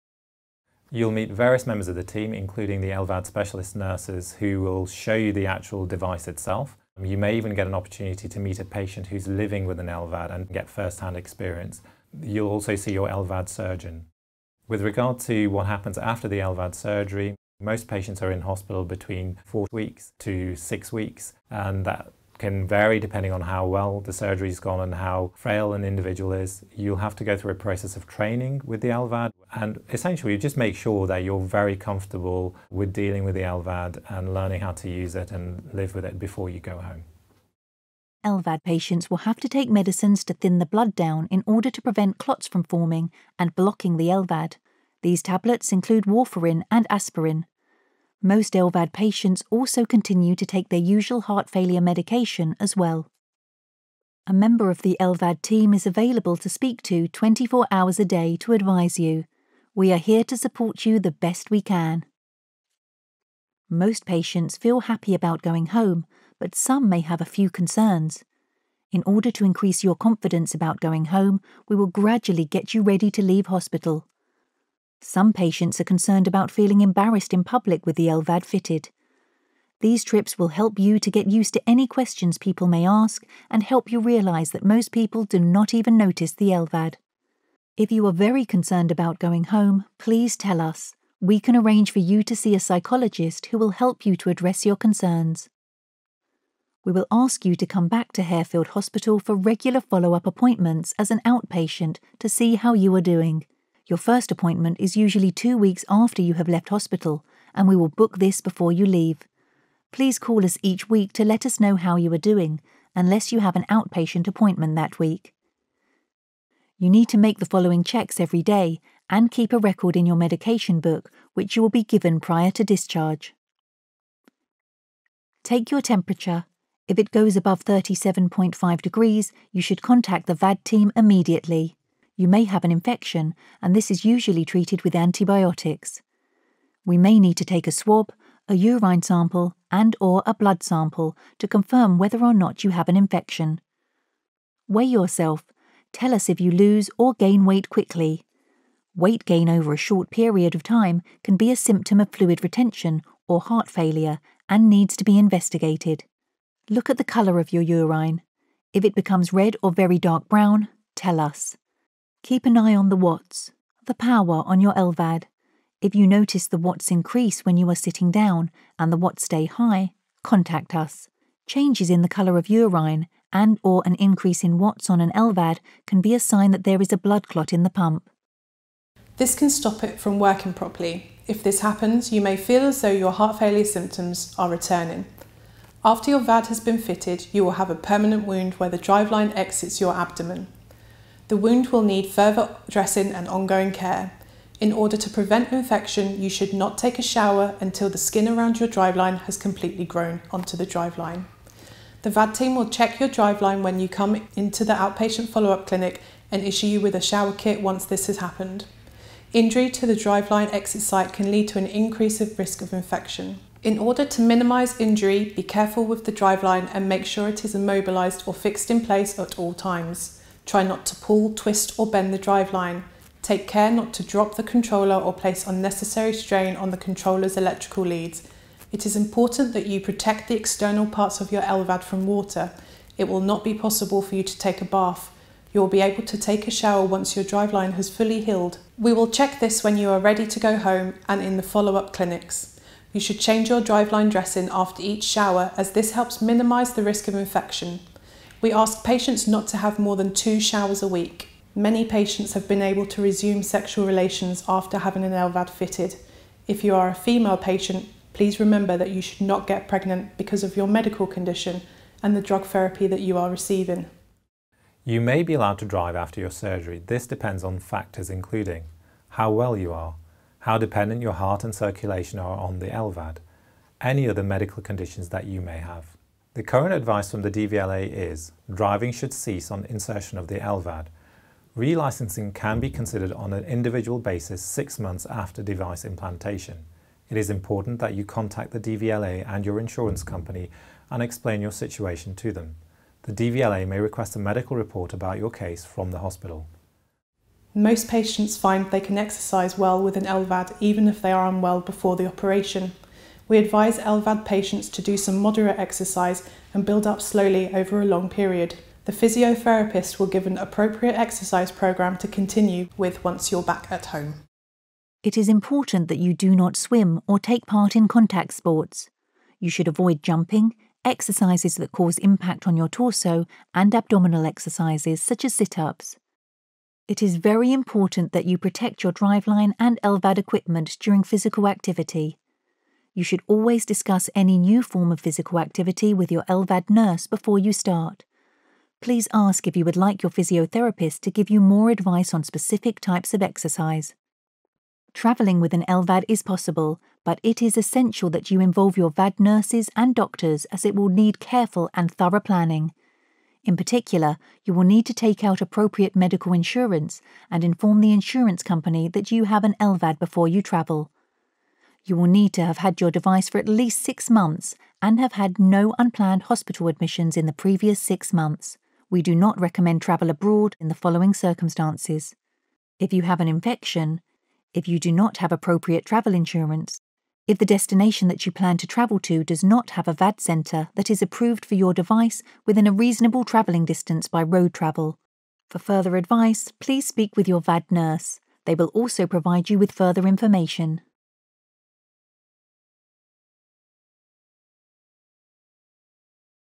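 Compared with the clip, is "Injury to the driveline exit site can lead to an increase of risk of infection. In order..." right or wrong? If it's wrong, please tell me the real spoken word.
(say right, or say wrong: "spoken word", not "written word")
right.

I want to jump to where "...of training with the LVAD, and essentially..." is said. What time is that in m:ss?
0:27.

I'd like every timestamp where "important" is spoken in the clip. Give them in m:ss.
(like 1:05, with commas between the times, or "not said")
3:48, 4:47, 5:15, 5:27.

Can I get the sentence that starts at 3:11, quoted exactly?
The wound will need further dressing and ongoing care.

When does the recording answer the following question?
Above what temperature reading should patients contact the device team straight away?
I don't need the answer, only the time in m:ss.
2:07.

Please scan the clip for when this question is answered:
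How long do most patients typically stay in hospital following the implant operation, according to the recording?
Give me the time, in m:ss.
0:19.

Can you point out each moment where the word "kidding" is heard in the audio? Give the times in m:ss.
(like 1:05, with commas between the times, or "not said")
not said.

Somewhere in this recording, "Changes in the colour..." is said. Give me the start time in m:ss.
2:51.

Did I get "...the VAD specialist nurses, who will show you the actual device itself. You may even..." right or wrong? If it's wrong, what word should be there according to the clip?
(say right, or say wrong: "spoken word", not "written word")
wrong: "LVAD", not "VAD".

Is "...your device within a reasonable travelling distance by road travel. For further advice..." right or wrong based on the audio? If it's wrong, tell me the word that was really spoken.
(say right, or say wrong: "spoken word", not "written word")
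right.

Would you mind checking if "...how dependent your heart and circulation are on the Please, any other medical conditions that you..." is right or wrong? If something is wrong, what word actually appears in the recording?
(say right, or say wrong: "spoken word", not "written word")
wrong: "LVAD", not "Please".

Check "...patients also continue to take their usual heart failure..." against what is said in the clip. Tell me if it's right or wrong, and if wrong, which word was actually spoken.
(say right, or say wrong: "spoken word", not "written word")
right.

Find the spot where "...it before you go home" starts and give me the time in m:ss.
0:36.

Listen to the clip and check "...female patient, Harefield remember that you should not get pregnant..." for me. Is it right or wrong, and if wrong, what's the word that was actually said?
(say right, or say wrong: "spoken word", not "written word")
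wrong: "Please", not "Harefield".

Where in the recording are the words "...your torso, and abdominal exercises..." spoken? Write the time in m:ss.
5:22.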